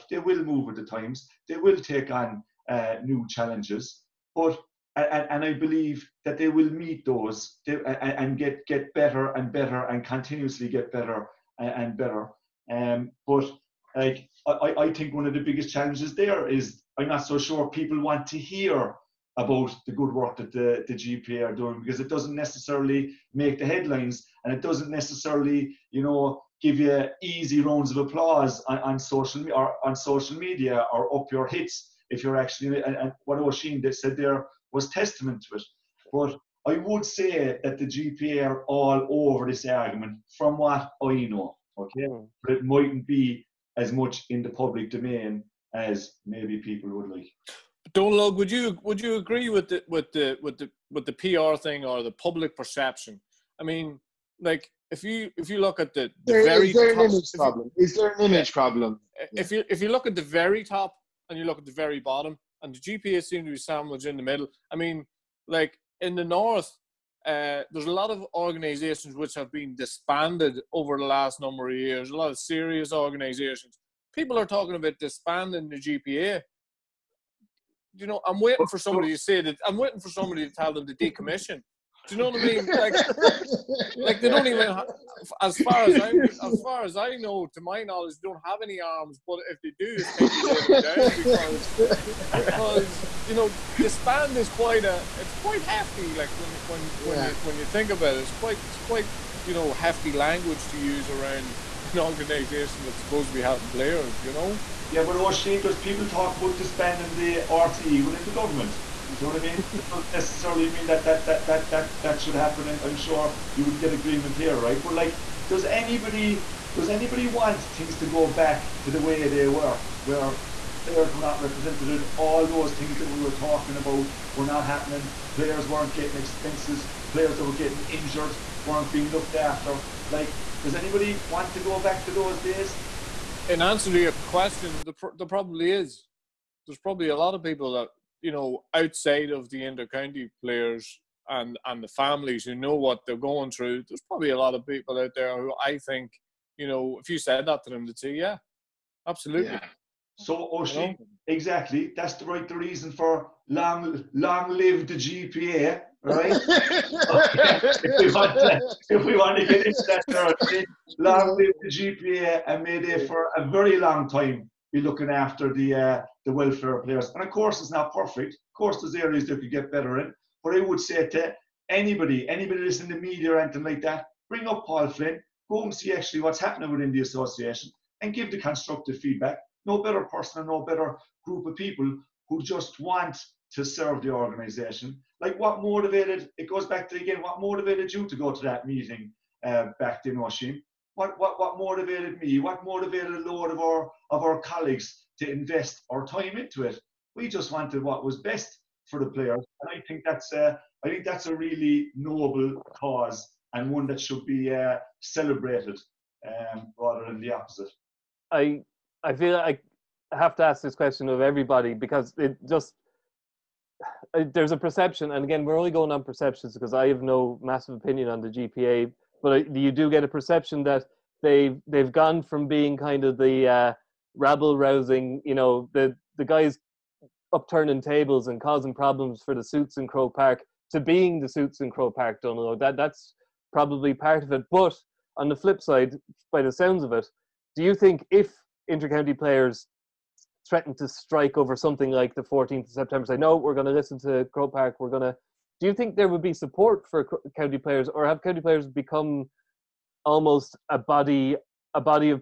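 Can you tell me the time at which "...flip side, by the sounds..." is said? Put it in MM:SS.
03:55.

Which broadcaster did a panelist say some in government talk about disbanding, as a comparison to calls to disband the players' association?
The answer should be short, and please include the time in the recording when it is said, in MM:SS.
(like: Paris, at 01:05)
RTE, at 01:47.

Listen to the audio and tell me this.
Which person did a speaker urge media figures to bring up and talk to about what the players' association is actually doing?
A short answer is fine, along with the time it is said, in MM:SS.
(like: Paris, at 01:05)
Paul Flynn, at 02:54.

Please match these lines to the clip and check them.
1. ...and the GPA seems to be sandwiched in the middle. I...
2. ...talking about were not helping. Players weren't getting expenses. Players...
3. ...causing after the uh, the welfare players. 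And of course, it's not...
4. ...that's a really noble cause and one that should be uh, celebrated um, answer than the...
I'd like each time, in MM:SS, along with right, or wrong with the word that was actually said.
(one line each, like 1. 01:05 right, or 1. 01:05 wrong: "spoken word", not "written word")
1. 01:02 right
2. 02:03 wrong: "happening", not "helping"
3. 02:44 wrong: "looking", not "causing"
4. 03:21 wrong: "rather", not "answer".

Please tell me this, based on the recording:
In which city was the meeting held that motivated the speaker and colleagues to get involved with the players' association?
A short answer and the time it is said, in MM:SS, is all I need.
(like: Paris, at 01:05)
Washington, at 03:10.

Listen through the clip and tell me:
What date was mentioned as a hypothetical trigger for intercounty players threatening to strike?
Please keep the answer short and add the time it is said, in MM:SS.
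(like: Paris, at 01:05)
14th of September, at 04:02.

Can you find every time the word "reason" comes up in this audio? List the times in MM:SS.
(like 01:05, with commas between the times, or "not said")
02:32.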